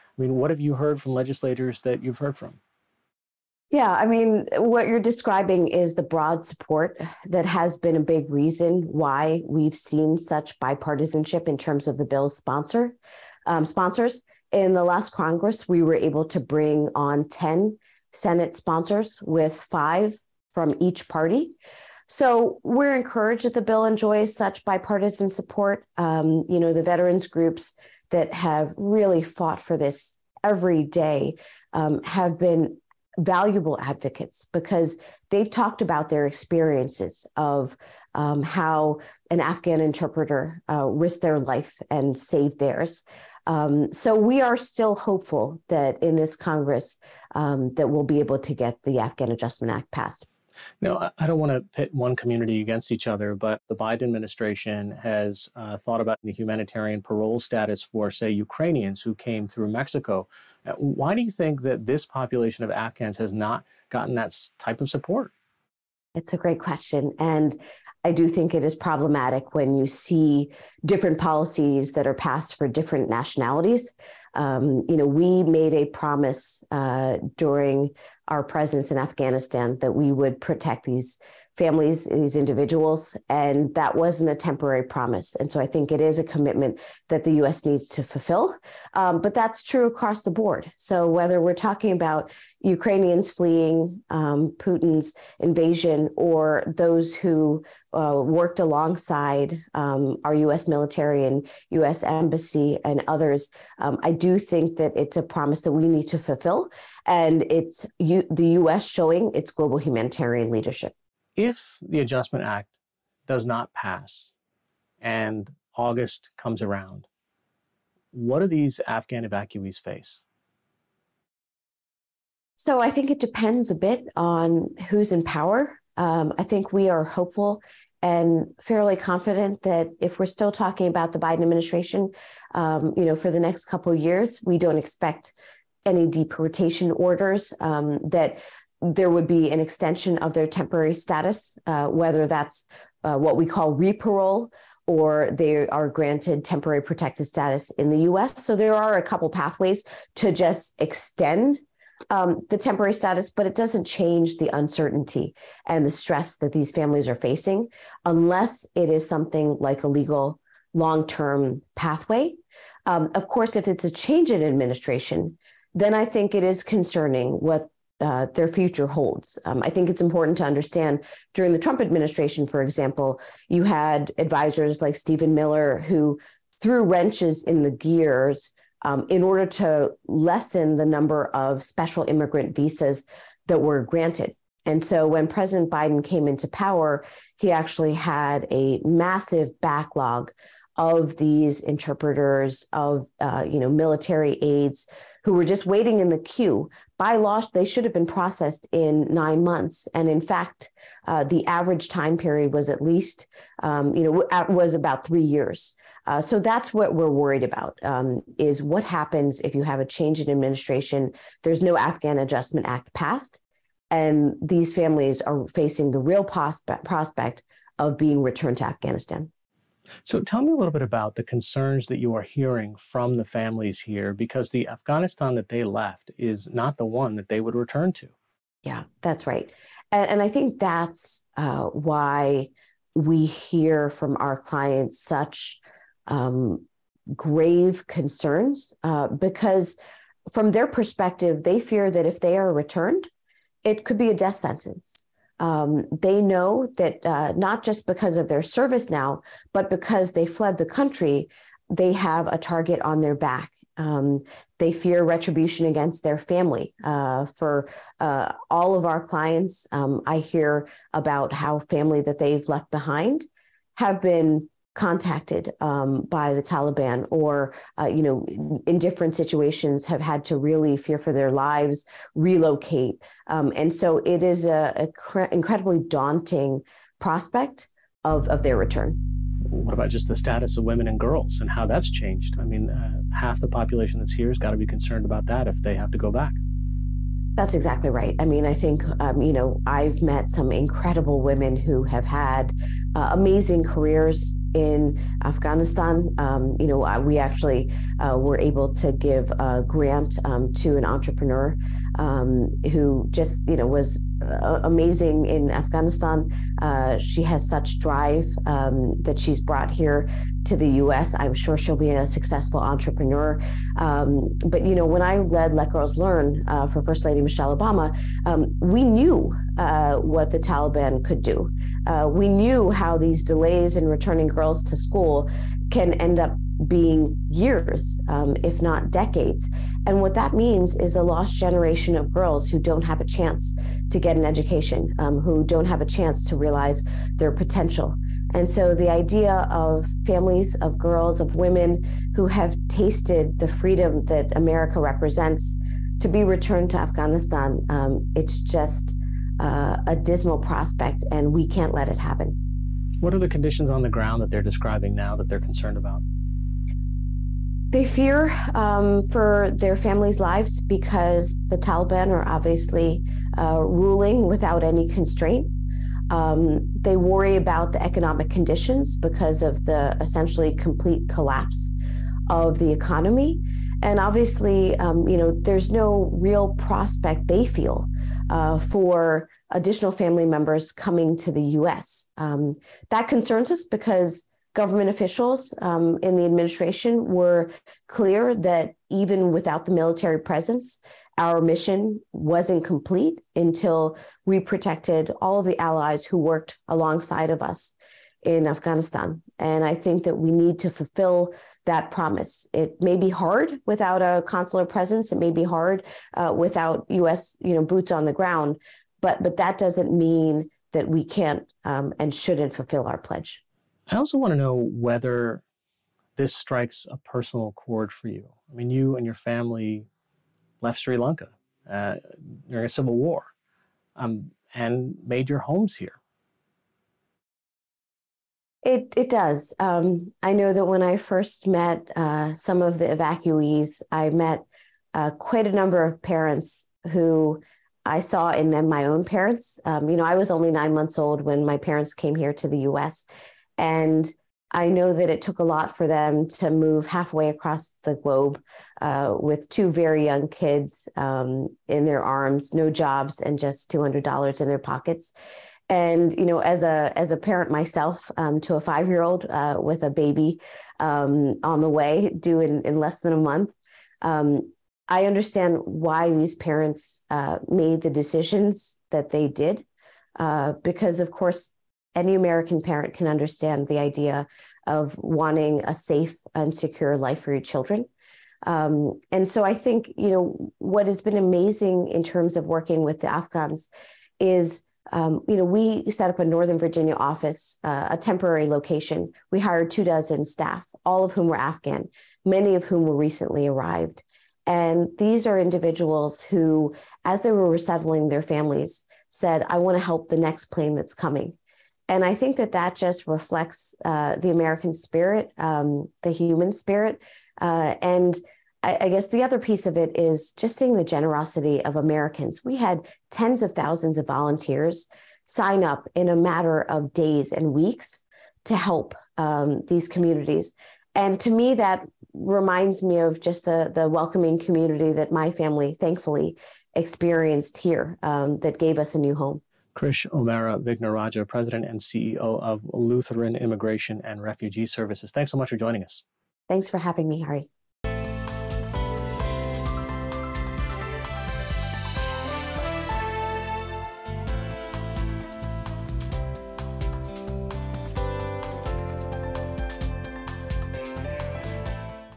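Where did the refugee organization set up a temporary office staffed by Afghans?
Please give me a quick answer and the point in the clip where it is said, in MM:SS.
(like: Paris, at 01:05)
Northern Virginia, at 08:06.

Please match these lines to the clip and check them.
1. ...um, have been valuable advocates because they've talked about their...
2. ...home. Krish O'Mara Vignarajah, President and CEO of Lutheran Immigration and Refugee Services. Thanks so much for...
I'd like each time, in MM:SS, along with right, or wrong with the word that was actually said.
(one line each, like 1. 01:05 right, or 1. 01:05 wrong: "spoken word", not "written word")
1. 00:31 right
2. 08:49 right.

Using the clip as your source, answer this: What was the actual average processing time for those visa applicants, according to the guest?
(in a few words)
3 years.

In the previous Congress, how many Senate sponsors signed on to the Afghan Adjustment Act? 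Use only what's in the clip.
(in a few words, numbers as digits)
10.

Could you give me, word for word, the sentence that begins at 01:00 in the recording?
Uh, why do you think that this population of Afghans has not gotten that type of support?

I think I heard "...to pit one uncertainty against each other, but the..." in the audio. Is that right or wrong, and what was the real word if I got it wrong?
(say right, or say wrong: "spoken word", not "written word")
wrong: "community", not "uncertainty".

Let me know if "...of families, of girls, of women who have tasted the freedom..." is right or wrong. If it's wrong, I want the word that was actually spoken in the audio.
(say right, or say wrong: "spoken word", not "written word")
right.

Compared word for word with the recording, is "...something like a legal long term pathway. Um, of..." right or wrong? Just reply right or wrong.
right.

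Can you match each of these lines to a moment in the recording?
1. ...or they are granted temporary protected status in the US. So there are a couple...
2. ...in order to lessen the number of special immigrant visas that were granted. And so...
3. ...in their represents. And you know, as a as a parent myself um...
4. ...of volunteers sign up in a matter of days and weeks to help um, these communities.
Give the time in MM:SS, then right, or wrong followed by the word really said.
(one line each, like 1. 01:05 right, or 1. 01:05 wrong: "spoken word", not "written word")
1. 02:24 right
2. 02:59 right
3. 07:34 wrong: "pockets", not "represents"
4. 08:33 right.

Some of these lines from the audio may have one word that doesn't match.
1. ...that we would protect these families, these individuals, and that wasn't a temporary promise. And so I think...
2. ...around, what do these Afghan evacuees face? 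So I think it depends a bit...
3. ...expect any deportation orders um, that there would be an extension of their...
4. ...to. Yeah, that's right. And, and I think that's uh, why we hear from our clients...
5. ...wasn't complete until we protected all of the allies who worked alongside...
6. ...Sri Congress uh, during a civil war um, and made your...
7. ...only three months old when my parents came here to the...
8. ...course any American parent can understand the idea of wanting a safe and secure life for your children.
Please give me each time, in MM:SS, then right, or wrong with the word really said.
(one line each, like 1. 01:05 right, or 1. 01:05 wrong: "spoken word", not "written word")
1. 01:19 right
2. 01:56 right
3. 02:14 right
4. 03:47 right
5. 06:32 right
6. 07:00 wrong: "Lanka", not "Congress"
7. 07:20 wrong: "nine", not "three"
8. 07:51 right.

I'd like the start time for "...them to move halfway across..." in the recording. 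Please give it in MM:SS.
07:25.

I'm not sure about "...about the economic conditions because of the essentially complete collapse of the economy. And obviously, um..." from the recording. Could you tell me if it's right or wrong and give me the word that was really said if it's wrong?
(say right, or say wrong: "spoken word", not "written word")
right.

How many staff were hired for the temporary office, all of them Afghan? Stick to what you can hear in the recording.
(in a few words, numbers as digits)
24.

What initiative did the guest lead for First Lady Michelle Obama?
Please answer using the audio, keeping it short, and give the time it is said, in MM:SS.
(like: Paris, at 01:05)
Let Girls Learn, at 05:15.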